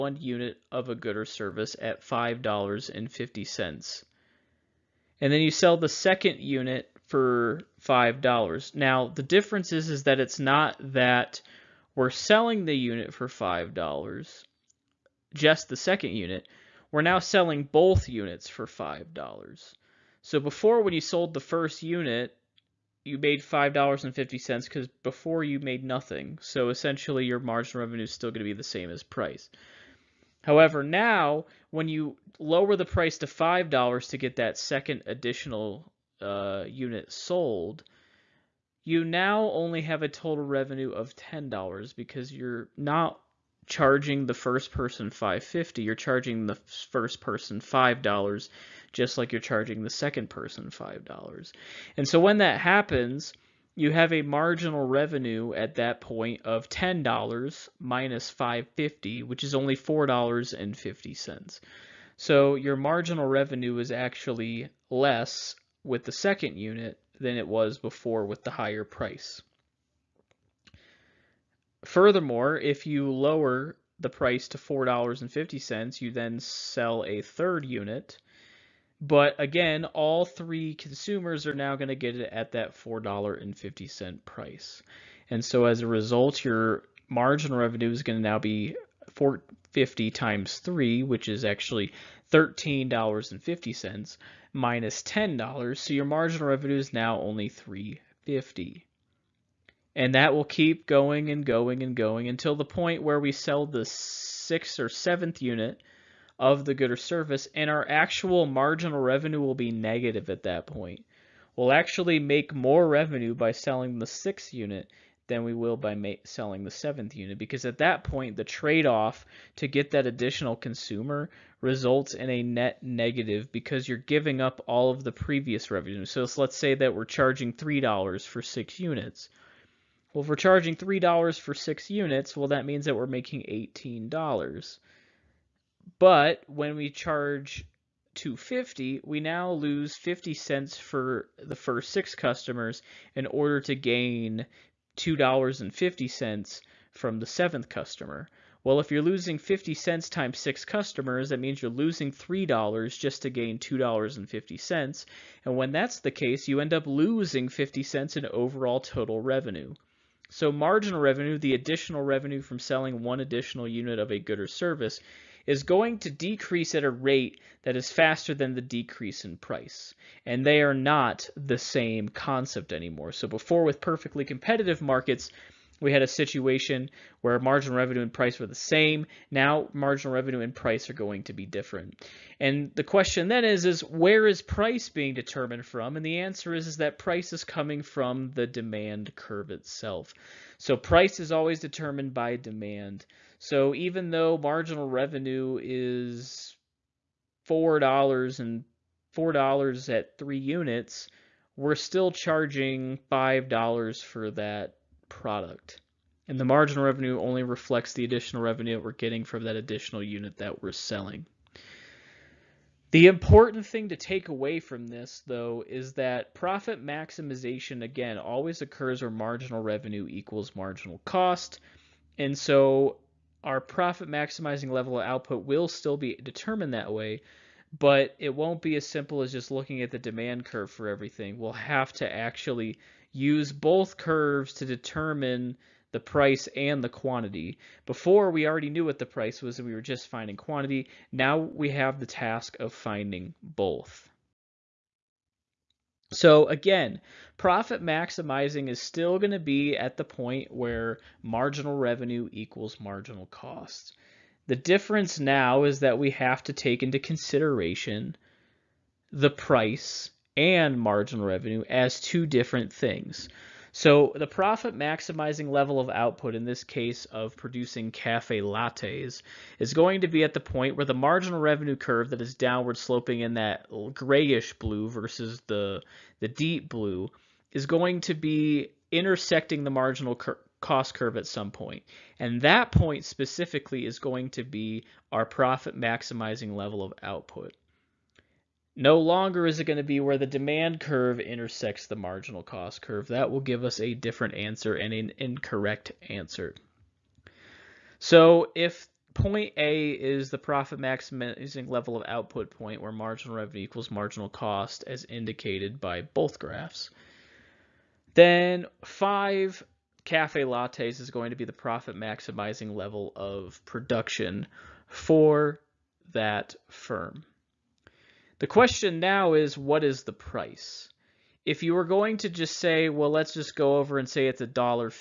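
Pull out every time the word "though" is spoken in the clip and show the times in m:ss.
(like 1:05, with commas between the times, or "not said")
3:14, 3:35.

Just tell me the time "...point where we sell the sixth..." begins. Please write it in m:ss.
1:42.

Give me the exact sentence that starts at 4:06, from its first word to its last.
So again, profit maximizing is still going to be at the point where marginal revenue equals marginal cost.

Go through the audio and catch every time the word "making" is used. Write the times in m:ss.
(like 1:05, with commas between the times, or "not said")
2:13.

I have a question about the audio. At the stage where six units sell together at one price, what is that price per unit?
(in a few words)
$3.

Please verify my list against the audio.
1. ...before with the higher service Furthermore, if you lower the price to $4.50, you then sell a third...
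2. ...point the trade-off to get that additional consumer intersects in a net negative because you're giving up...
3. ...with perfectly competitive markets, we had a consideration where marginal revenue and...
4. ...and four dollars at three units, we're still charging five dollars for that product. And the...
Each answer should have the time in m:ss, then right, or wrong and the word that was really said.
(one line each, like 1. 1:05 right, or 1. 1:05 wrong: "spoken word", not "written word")
1. 1:07 wrong: "price", not "service"
2. 1:58 wrong: "results", not "intersects"
3. 2:53 wrong: "situation", not "consideration"
4. 3:18 right.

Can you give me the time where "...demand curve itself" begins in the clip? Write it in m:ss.
3:08.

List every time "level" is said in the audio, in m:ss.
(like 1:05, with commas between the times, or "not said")
3:44, 4:25, 4:46, 5:01, 5:12.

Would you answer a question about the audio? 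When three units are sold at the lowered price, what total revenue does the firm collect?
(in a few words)
$13.50.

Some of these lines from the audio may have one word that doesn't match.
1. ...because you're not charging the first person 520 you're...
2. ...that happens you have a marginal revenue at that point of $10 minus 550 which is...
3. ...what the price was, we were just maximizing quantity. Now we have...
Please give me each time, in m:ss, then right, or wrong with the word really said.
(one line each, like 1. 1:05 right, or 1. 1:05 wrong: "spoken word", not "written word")
1. 0:41 wrong: "550", not "520"
2. 0:52 right
3. 3:58 wrong: "finding", not "maximizing".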